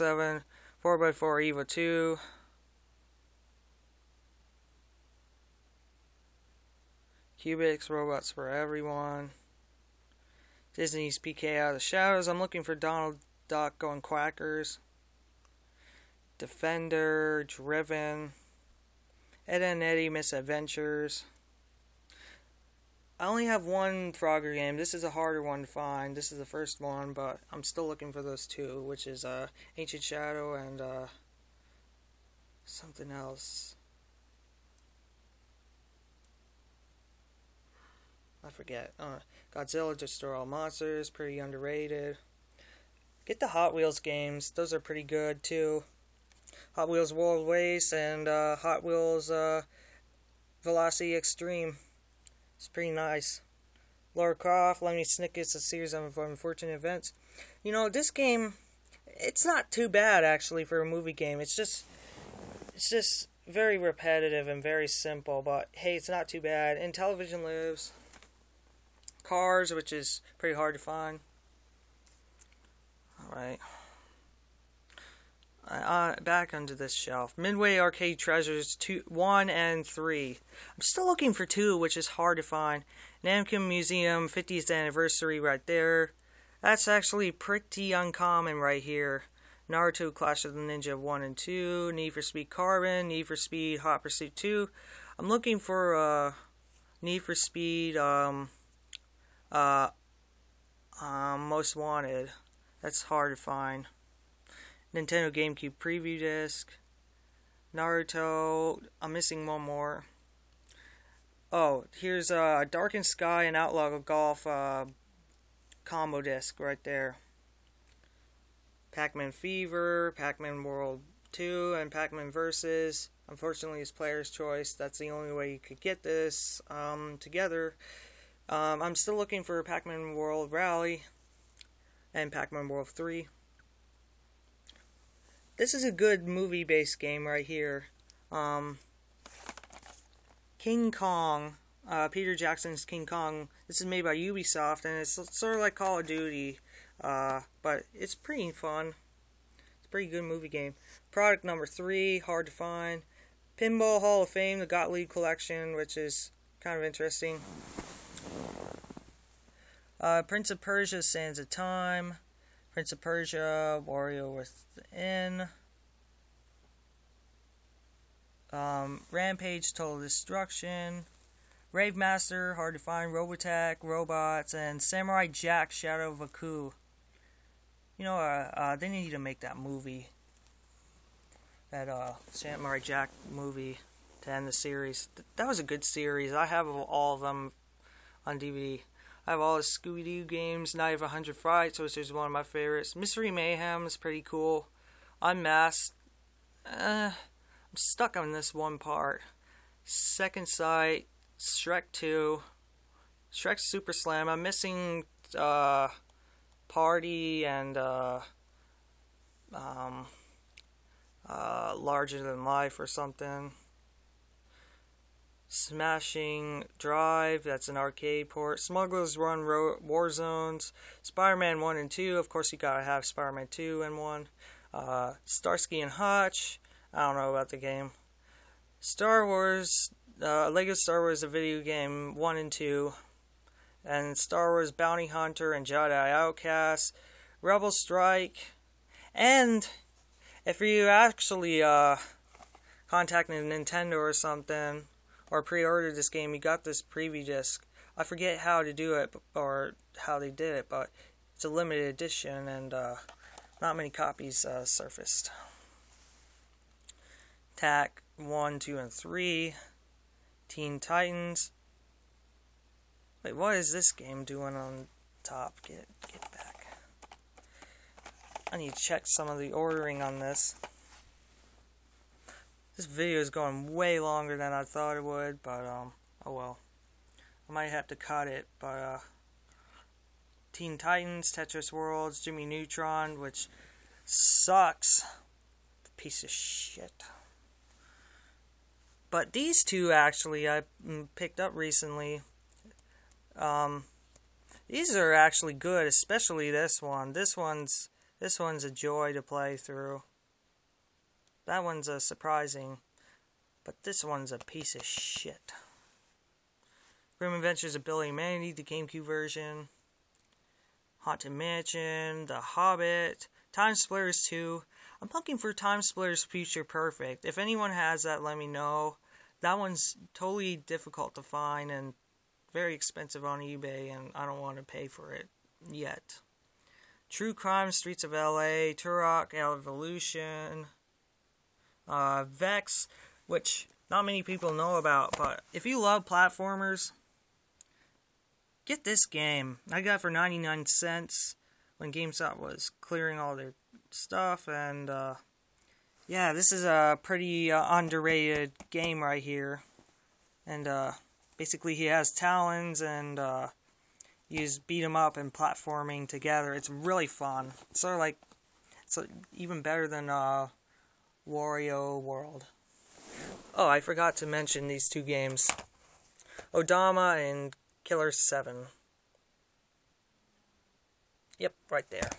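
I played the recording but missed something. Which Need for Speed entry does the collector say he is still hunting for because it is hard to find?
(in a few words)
Most Wanted.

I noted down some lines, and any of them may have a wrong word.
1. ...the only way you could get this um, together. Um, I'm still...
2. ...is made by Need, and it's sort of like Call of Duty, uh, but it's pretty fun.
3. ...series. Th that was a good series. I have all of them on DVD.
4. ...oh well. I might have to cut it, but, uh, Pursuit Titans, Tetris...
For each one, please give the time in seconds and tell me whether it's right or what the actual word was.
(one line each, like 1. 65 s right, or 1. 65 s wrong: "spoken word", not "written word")
1. 124 s right
2. 143 s wrong: "Ubisoft", not "Need"
3. 184 s right
4. 276 s wrong: "Teen", not "Pursuit".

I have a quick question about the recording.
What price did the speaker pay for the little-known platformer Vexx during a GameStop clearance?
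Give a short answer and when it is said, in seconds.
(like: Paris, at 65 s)
99 cents, at 340 s.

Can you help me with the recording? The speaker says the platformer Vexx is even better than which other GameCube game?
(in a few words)
Wario World.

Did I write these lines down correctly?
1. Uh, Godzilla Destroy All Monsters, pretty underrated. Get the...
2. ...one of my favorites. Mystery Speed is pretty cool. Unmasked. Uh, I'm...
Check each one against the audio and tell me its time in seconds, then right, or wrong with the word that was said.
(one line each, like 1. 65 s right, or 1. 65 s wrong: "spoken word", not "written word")
1. 38 s right
2. 192 s wrong: "Mayhem", not "Speed".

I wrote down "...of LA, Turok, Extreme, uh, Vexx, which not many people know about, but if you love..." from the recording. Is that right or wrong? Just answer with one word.
wrong.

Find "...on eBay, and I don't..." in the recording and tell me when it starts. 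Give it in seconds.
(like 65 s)
323 s.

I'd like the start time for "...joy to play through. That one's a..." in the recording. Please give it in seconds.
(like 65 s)
298 s.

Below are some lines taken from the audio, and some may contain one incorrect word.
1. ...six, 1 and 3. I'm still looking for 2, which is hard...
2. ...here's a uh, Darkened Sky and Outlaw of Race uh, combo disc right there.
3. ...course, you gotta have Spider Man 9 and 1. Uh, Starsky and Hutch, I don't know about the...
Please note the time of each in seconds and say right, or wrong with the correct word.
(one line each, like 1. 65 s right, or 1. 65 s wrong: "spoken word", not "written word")
1. 78 s wrong: "two", not "six"
2. 111 s wrong: "Golf", not "Race"
3. 222 s wrong: "2", not "9".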